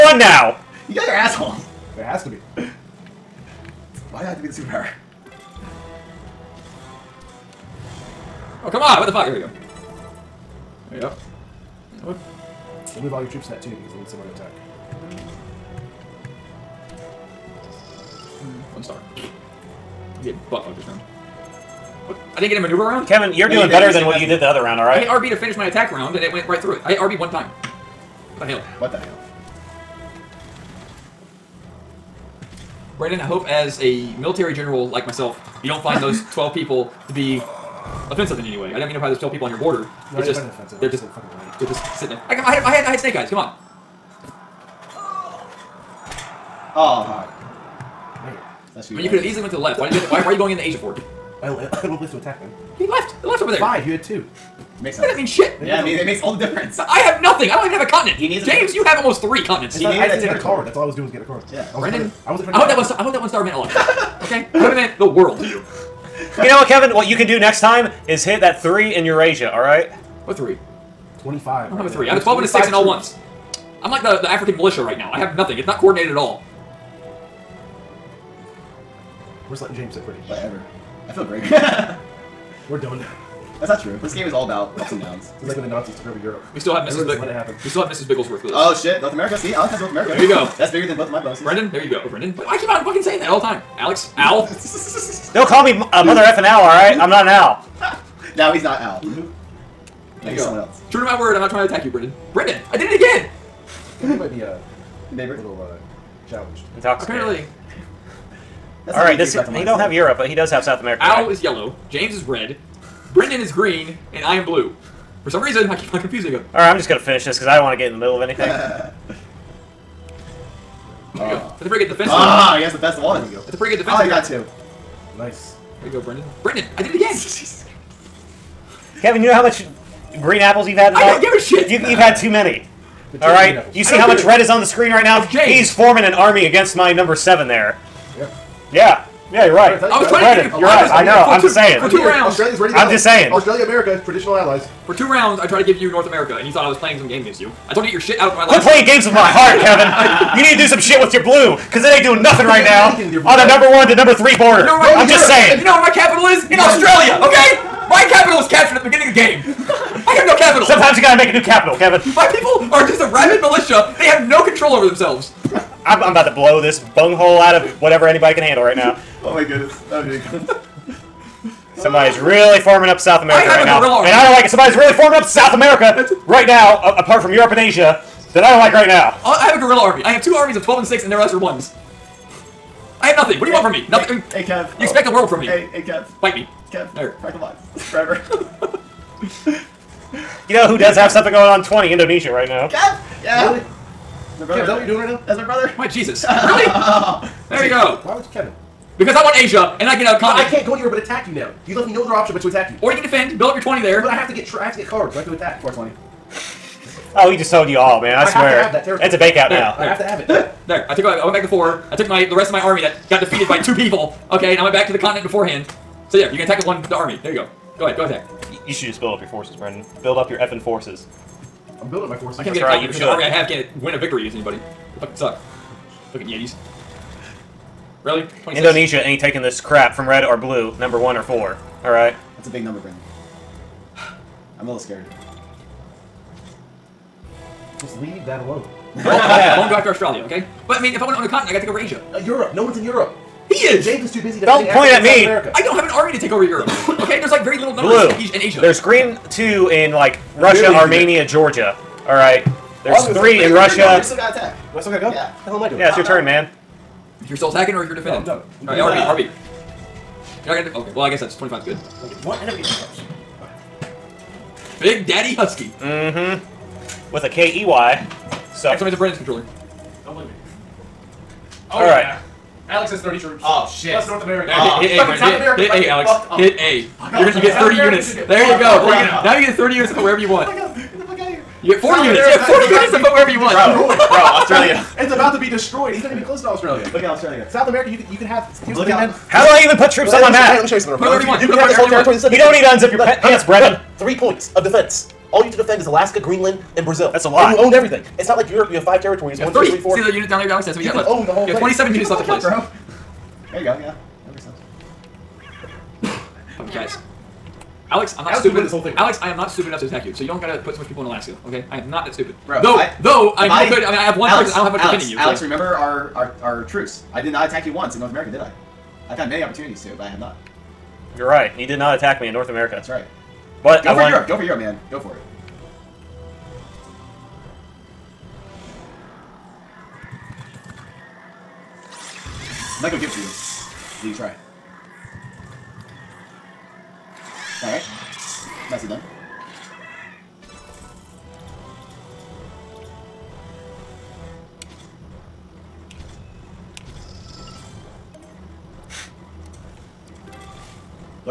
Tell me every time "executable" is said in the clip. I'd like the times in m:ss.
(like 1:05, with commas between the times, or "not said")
not said.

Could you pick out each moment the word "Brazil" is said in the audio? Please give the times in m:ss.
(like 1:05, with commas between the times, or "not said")
4:56.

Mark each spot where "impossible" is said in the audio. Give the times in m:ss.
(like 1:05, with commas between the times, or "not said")
not said.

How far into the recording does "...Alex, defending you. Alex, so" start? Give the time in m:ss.
5:14.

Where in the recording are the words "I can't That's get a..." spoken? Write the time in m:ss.
3:42.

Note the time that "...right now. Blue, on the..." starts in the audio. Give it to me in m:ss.
2:32.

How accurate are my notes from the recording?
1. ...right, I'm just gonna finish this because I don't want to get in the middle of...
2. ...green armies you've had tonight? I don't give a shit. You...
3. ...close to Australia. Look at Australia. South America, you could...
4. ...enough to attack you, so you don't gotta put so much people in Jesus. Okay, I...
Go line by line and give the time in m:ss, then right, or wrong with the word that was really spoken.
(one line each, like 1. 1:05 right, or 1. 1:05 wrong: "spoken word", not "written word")
1. 1:56 right
2. 2:10 wrong: "apples", not "armies"
3. 4:46 right
4. 5:09 wrong: "Alaska", not "Jesus".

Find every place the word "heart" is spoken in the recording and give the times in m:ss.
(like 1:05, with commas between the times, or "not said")
2:29.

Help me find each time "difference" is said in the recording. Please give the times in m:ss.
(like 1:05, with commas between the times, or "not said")
0:56.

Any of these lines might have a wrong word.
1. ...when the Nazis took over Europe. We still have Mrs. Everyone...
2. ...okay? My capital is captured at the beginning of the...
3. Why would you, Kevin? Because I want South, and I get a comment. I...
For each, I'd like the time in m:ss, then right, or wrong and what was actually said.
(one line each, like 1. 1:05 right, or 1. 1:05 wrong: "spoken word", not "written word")
1. 1:25 right
2. 2:37 right
3. 3:18 wrong: "Asia", not "South".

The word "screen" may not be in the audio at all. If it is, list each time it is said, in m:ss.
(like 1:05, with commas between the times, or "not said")
2:14.